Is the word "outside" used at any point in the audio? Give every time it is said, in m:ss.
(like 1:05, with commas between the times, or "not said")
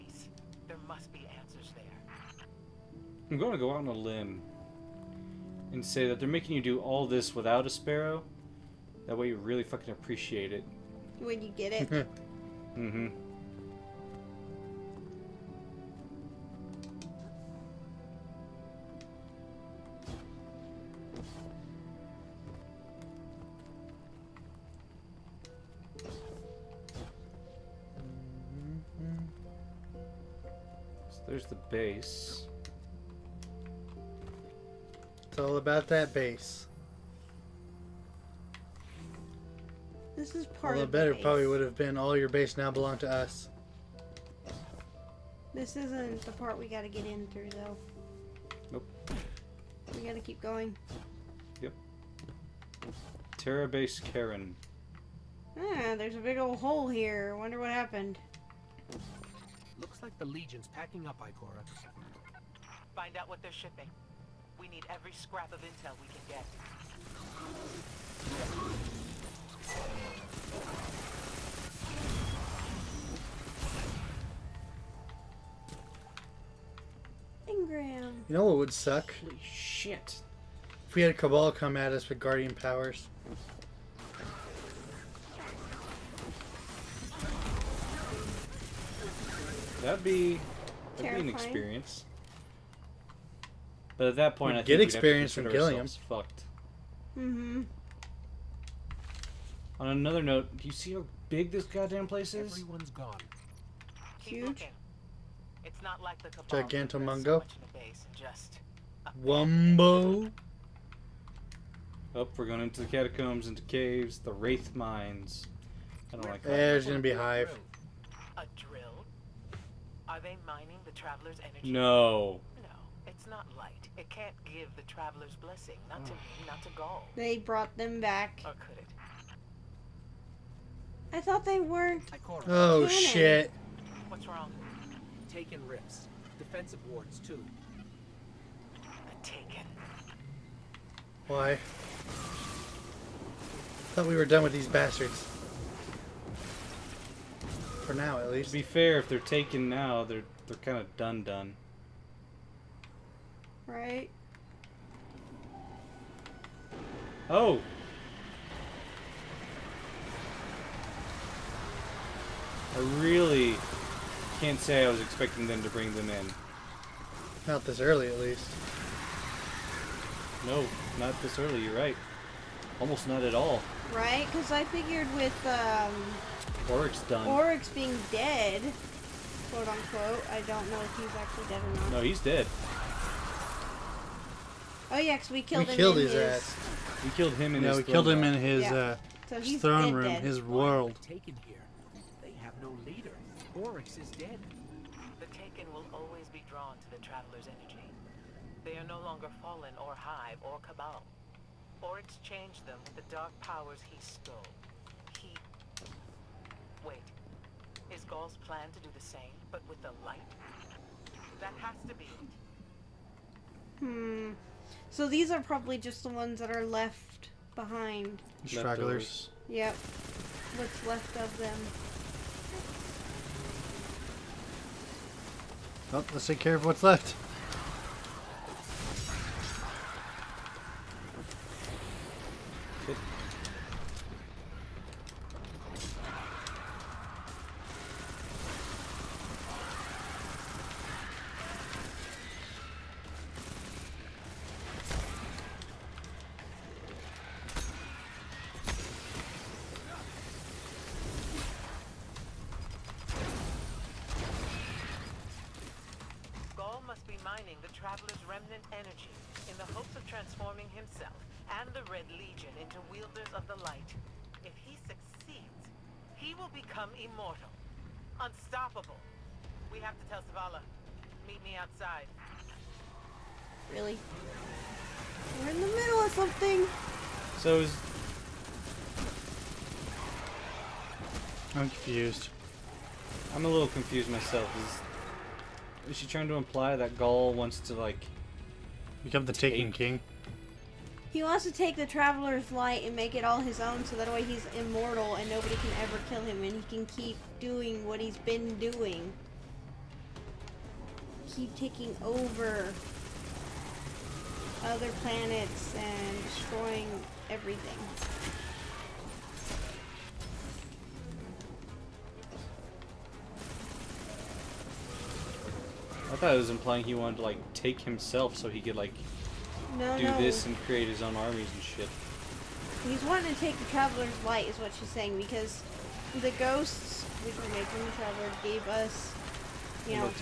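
4:31.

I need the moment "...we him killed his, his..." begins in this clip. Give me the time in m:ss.
3:05.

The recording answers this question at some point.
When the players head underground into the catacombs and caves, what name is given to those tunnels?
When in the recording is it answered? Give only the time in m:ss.
1:54.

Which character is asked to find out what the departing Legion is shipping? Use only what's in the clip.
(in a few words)
Ikora.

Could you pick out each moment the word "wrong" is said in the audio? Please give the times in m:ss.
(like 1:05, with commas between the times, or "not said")
2:14.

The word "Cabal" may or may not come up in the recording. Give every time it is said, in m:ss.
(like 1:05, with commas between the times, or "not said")
1:21, 3:20.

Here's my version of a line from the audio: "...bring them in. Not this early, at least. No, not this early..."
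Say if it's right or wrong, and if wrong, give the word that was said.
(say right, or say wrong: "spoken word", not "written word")
right.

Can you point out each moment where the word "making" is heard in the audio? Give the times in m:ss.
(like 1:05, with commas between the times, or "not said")
0:06, 5:27.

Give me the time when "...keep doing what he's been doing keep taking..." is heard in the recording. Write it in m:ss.
4:56.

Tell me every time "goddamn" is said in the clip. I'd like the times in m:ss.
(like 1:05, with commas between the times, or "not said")
1:41.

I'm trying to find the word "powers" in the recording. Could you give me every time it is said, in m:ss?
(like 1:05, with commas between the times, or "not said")
1:22, 3:23.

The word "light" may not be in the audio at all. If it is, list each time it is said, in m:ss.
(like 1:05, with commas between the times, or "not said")
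2:03, 3:30, 4:52, 5:24.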